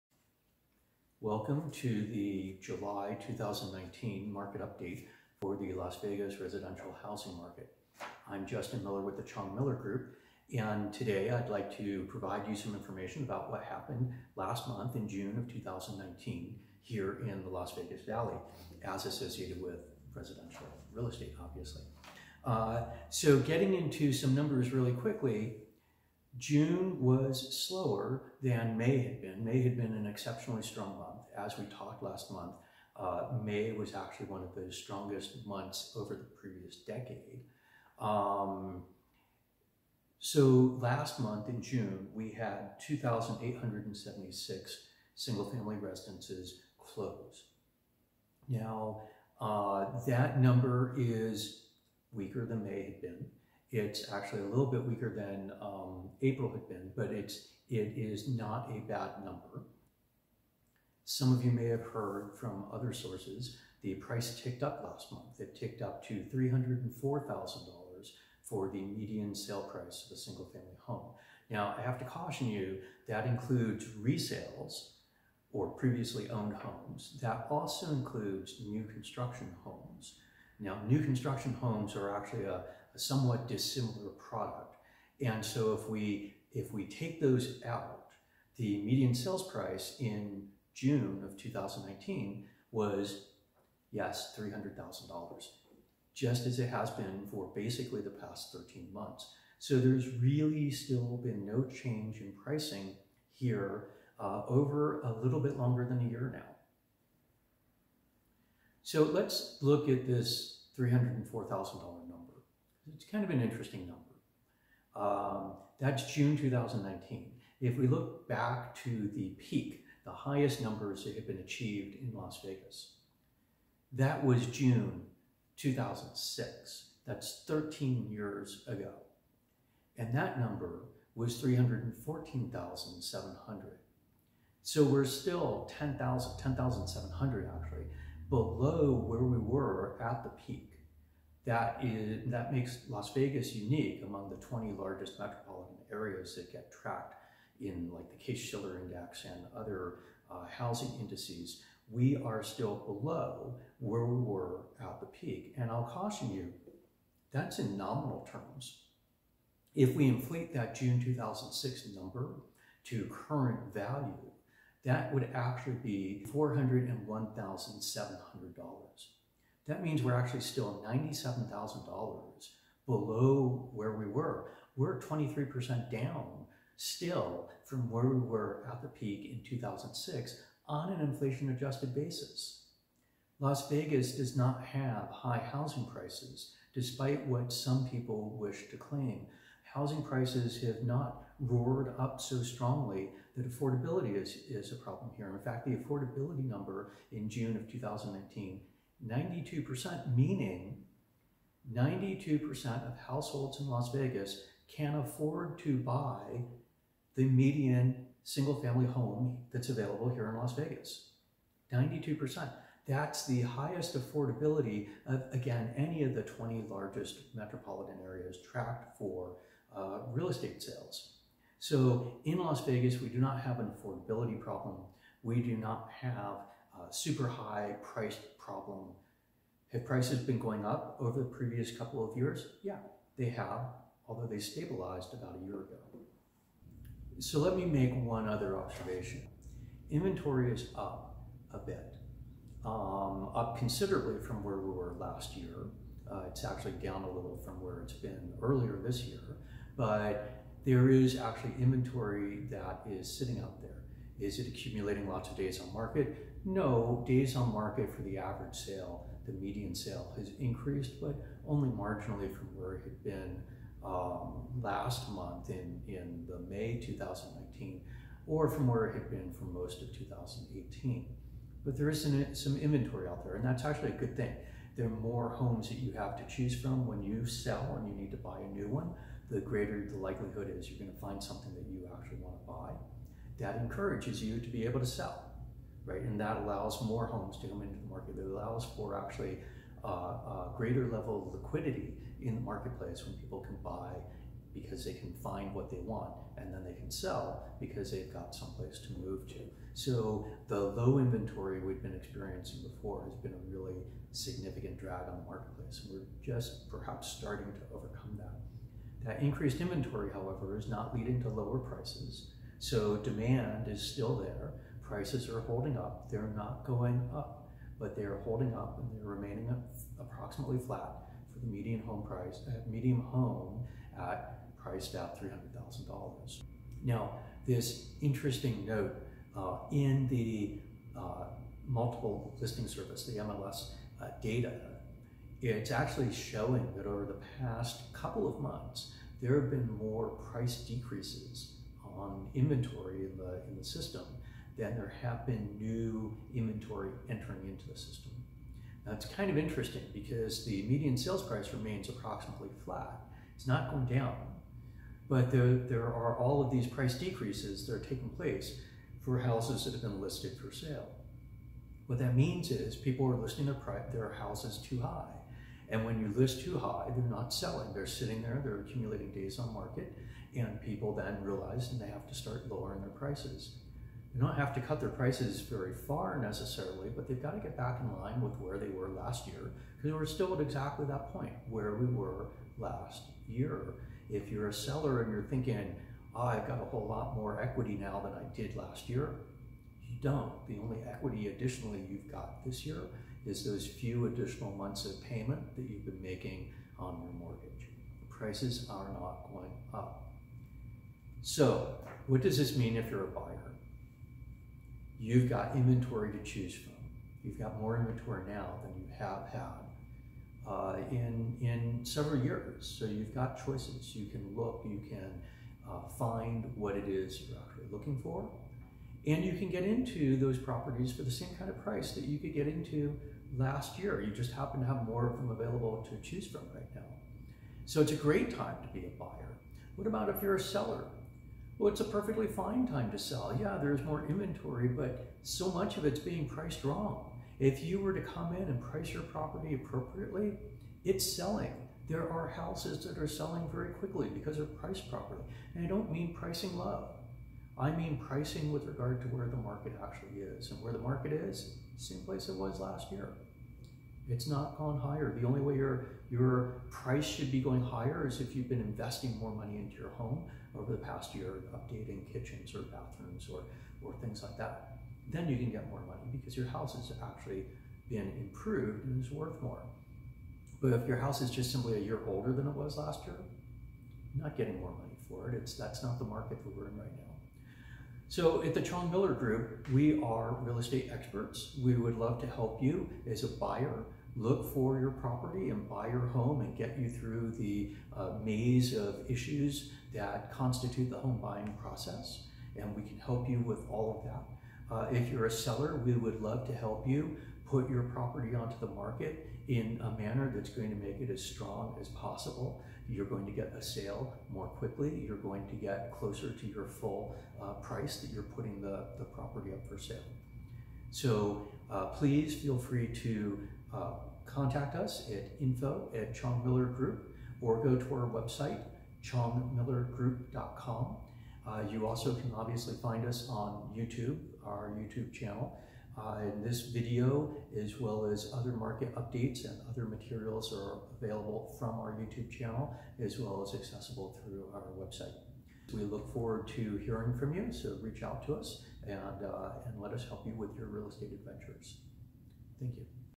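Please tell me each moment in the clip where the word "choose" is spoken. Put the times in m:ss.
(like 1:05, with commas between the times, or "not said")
4:36, 6:46, 7:06.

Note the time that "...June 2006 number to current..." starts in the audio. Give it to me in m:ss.
2:40.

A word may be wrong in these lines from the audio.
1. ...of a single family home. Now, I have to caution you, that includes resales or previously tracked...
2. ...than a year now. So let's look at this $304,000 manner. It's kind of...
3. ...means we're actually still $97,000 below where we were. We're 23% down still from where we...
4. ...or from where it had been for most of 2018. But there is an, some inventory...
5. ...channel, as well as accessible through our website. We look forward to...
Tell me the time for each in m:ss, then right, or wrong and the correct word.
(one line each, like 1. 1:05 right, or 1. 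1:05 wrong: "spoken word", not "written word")
1. 1:10 wrong: "owned", not "tracked"
2. 1:45 wrong: "number", not "manner"
3. 2:49 right
4. 4:28 right
5. 8:52 right.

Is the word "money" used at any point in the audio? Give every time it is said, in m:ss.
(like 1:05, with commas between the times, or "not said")
7:39, 7:45, 7:54.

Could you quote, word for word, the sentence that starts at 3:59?
Inventory is up a bit, um, up considerably from where we were last year.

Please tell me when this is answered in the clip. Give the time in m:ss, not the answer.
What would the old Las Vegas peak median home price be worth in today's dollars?
2:46.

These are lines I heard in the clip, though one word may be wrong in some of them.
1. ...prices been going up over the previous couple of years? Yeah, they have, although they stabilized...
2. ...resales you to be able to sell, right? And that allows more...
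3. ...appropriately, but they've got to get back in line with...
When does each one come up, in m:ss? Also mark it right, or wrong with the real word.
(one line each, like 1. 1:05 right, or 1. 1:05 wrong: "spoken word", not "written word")
1. 3:49 right
2. 4:43 wrong: "encourages", not "resales"
3. 6:16 wrong: "necessarily", not "appropriately".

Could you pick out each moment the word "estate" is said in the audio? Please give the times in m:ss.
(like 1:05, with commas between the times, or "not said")
0:21, 3:40, 8:00, 9:00.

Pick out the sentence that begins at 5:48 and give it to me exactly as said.
Now it's kind of interesting because the median sales price remains approximately flat.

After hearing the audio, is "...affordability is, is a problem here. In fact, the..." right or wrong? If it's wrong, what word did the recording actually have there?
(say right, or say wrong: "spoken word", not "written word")
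right.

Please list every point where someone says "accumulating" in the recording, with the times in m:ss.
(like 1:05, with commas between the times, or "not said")
4:14, 6:08.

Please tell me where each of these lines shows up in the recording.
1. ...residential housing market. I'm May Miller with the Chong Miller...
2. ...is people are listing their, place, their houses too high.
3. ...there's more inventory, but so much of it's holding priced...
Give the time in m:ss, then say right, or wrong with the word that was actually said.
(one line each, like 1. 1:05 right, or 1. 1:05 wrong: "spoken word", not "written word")
1. 0:06 wrong: "Justin", not "May"
2. 6:02 wrong: "price", not "place"
3. 7:13 wrong: "being", not "holding".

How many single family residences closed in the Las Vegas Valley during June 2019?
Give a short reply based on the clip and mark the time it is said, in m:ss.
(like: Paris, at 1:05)
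2,876, at 0:42.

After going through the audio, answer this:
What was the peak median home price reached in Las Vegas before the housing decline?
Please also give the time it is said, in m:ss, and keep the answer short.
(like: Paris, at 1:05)
$314,700, at 2:11.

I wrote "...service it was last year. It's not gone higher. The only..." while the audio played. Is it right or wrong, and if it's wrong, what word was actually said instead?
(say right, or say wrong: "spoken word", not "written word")
wrong: "place", not "service".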